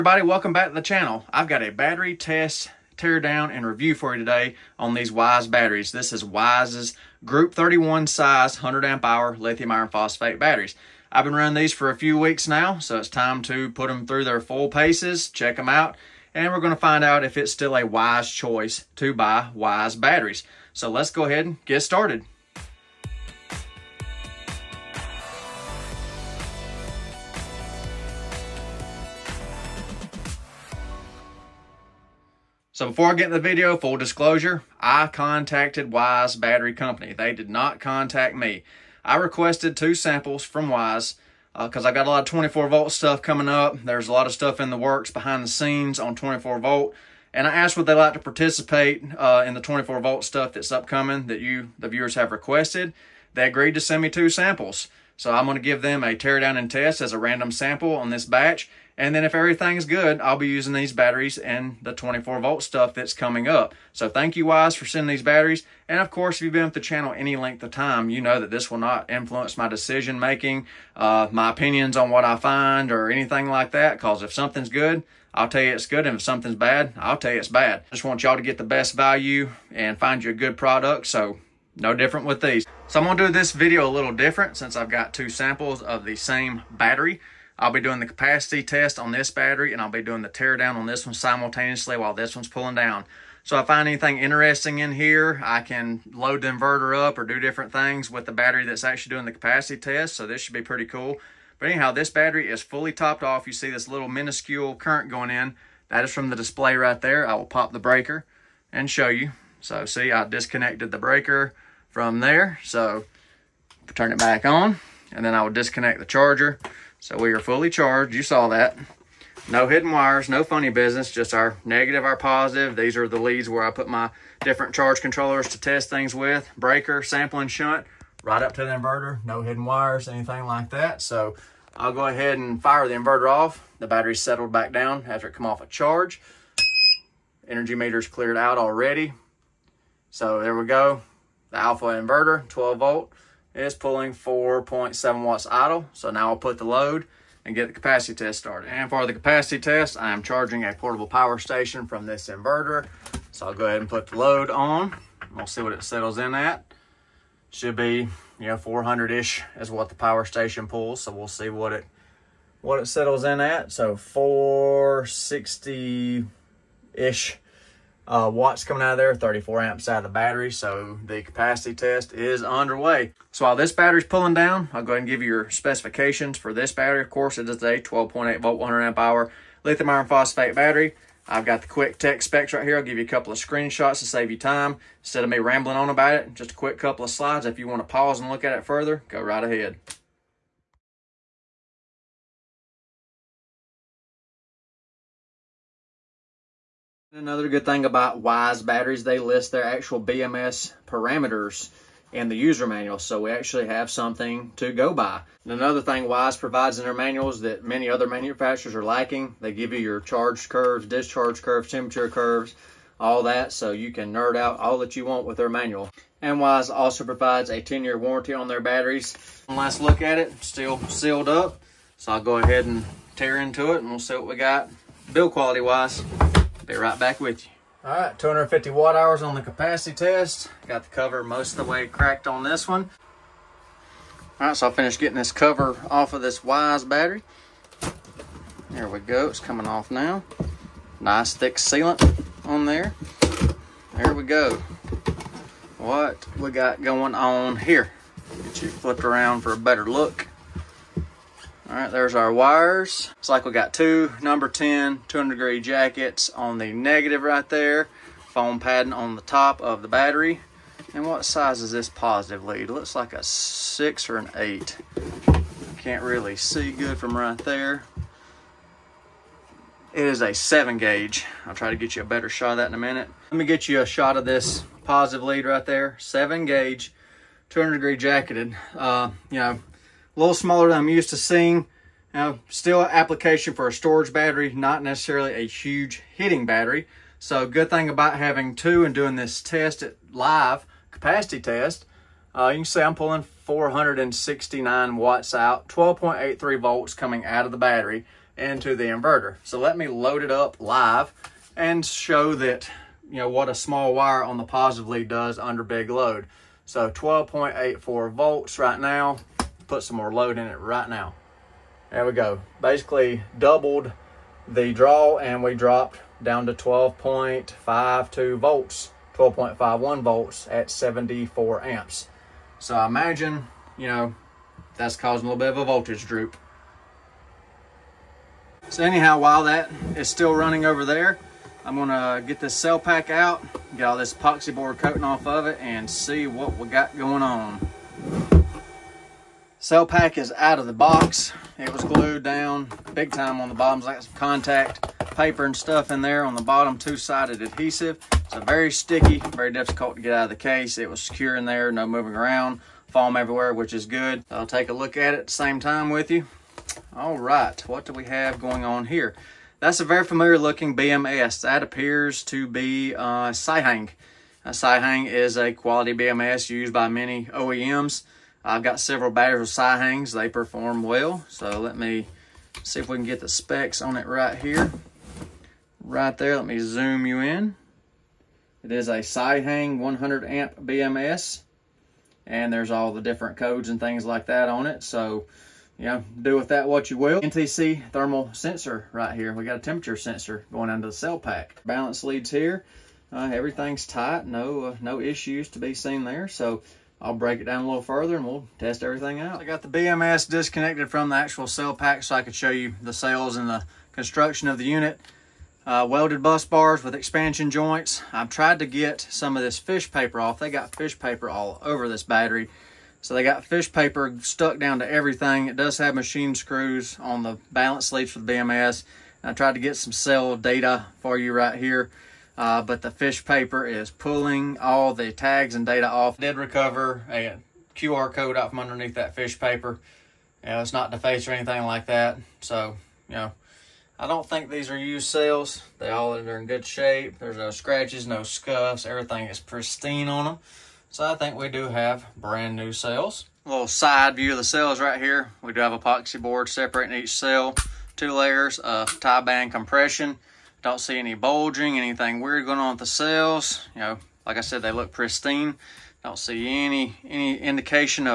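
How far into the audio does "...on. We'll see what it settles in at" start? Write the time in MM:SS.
02:34.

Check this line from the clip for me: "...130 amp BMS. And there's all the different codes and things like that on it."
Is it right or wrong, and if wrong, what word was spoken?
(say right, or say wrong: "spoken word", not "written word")
wrong: "100", not "130".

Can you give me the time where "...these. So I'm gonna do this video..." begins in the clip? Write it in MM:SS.
01:22.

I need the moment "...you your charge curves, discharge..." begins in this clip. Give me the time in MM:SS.
03:29.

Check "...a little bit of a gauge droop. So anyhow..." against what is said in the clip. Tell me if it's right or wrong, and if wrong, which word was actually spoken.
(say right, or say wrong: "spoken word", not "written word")
wrong: "voltage", not "gauge".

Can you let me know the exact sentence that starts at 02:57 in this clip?
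Of course, it is a 12.8 volt, 100 amp hour lithium iron phosphate battery.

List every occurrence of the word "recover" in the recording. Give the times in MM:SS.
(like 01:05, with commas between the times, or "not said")
07:06.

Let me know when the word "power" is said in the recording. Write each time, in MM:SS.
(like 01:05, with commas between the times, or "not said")
02:31, 02:39.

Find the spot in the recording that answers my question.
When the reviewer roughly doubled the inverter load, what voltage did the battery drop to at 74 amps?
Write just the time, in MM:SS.
05:19.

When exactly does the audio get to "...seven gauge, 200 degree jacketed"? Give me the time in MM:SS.
04:35.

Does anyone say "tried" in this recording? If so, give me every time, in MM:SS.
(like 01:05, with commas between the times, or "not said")
06:48, 06:59.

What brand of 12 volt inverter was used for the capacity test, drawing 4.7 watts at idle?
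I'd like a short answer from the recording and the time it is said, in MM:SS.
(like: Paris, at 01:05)
Alffaa, at 02:21.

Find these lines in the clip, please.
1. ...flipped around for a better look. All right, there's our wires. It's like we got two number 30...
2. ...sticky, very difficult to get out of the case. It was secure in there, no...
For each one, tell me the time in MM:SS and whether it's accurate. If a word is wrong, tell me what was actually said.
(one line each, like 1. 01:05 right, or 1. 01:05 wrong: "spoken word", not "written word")
1. 04:08 wrong: "10", not "30"
2. 05:48 right.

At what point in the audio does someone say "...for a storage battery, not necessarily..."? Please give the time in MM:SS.
04:43.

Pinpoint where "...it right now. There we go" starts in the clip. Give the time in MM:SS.
05:10.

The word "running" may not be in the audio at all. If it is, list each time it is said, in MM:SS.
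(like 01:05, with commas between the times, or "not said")
00:11, 05:30.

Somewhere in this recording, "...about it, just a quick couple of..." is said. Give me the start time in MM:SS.
03:05.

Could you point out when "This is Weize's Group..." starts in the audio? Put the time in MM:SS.
00:05.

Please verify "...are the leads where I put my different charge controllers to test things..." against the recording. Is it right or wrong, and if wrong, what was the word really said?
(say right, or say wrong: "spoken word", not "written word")
right.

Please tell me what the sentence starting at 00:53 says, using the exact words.
They agreed to send me two samples.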